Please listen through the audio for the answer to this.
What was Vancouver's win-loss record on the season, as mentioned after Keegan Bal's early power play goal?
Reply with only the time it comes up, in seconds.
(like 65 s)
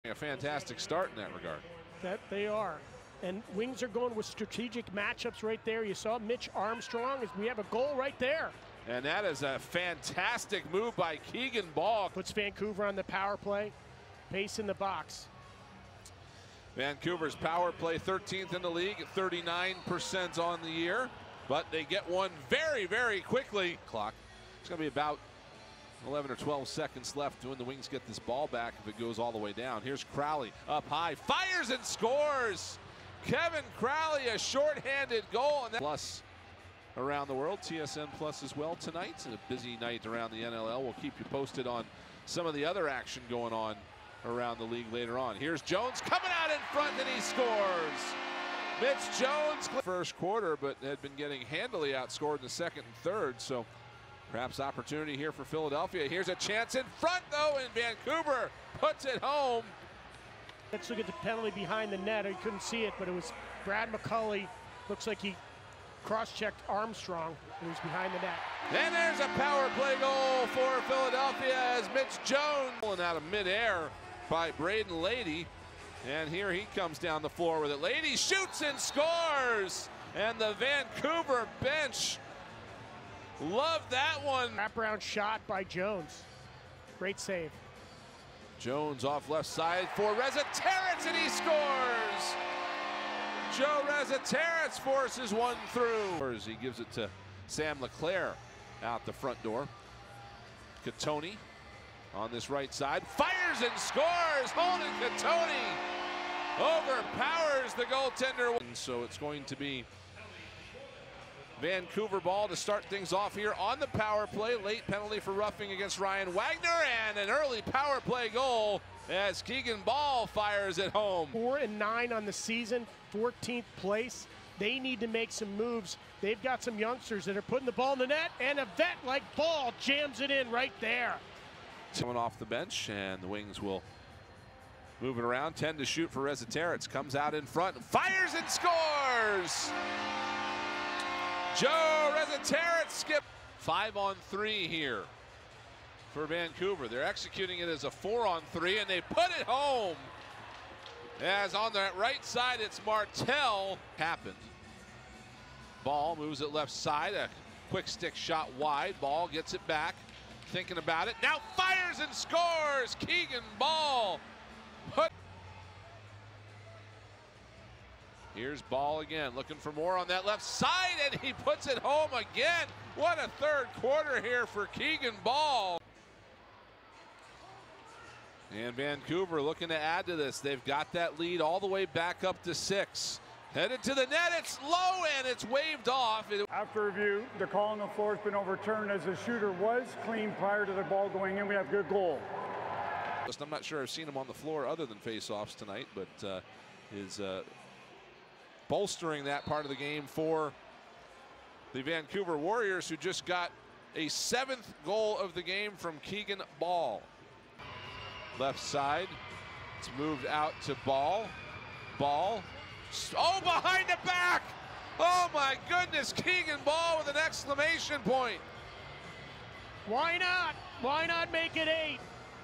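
121 s.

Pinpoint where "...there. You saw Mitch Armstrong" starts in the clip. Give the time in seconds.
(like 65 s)
5 s.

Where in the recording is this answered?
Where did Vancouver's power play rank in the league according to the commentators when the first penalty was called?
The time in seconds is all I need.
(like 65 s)
17 s.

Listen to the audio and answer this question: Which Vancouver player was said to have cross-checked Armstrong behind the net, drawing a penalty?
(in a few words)
Brad McCulley.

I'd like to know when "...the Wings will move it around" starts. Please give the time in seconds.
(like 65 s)
133 s.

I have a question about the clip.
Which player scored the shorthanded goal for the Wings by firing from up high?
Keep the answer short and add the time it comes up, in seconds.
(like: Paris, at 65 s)
Kevin Crowley, at 33 s.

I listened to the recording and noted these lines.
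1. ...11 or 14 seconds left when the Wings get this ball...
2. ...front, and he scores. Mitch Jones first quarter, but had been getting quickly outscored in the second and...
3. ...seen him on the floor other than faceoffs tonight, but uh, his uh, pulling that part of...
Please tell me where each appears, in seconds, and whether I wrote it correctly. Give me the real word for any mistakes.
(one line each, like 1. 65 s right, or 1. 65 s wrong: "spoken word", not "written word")
1. 26 s wrong: "12", not "14"
2. 46 s wrong: "handily", not "quickly"
3. 193 s wrong: "bolstering", not "pulling".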